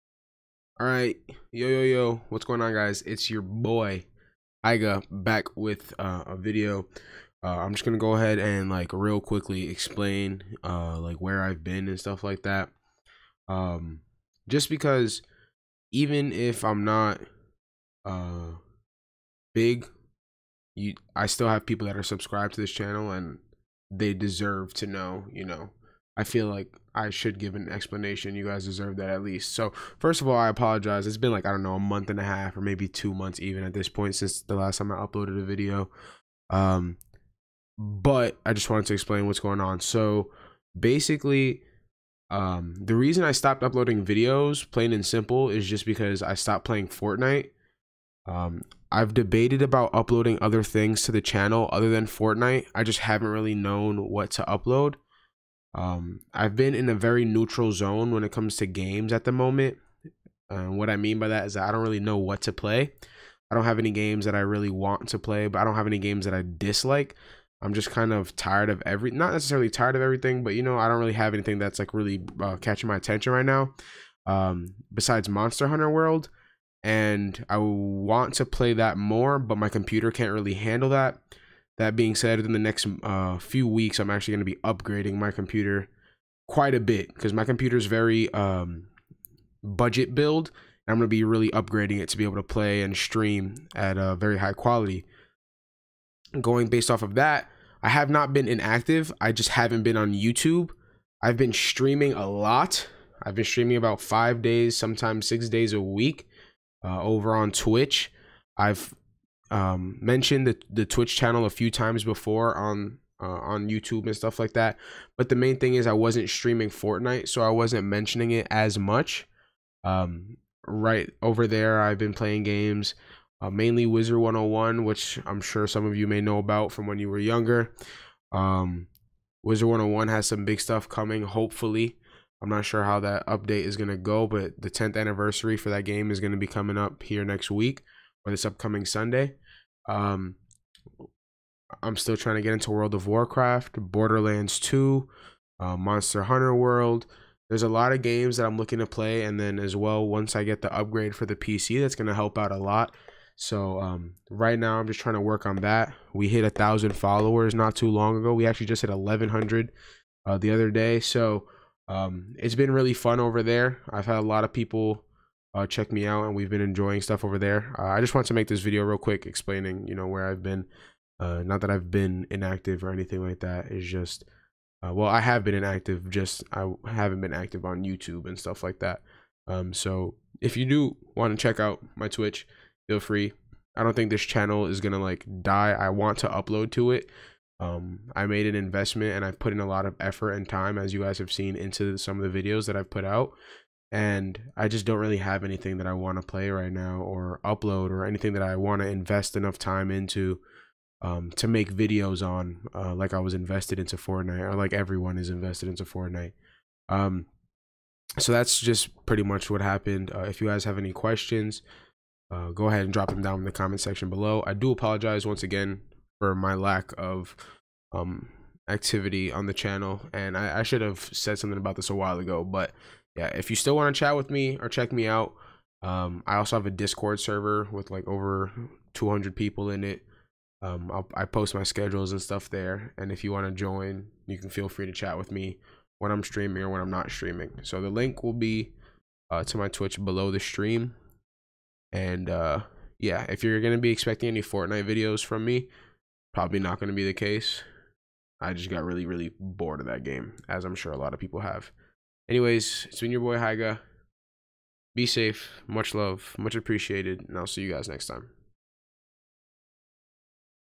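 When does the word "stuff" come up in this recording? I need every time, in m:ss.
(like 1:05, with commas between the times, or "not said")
0:11, 1:54, 2:10, 2:47, 2:58, 3:52.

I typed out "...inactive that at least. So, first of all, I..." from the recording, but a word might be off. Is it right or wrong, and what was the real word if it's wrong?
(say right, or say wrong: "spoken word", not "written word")
wrong: "deserve", not "inactive".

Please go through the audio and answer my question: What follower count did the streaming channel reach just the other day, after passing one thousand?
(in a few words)
1,100.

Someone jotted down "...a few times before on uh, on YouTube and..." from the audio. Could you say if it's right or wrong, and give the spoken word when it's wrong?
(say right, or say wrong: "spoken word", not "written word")
right.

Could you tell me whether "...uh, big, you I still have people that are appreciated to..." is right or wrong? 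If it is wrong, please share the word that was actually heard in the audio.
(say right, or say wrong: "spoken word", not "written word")
wrong: "subscribed", not "appreciated".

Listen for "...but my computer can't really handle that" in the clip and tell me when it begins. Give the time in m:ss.
1:19.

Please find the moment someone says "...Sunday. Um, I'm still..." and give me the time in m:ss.
2:18.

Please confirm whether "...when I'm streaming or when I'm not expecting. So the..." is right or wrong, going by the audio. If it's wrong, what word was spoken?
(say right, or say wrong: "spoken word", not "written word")
wrong: "streaming", not "expecting".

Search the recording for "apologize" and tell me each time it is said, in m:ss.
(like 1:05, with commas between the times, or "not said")
0:30, 3:34.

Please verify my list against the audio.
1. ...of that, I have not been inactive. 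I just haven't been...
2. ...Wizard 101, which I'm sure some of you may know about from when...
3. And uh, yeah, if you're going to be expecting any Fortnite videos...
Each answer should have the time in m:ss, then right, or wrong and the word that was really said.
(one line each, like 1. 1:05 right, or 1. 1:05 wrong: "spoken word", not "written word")
1. 1:37 right
2. 2:03 right
3. 4:01 right.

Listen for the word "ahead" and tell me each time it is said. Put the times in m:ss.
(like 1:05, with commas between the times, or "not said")
0:08, 3:32.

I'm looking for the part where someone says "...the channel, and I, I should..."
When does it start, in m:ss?
3:39.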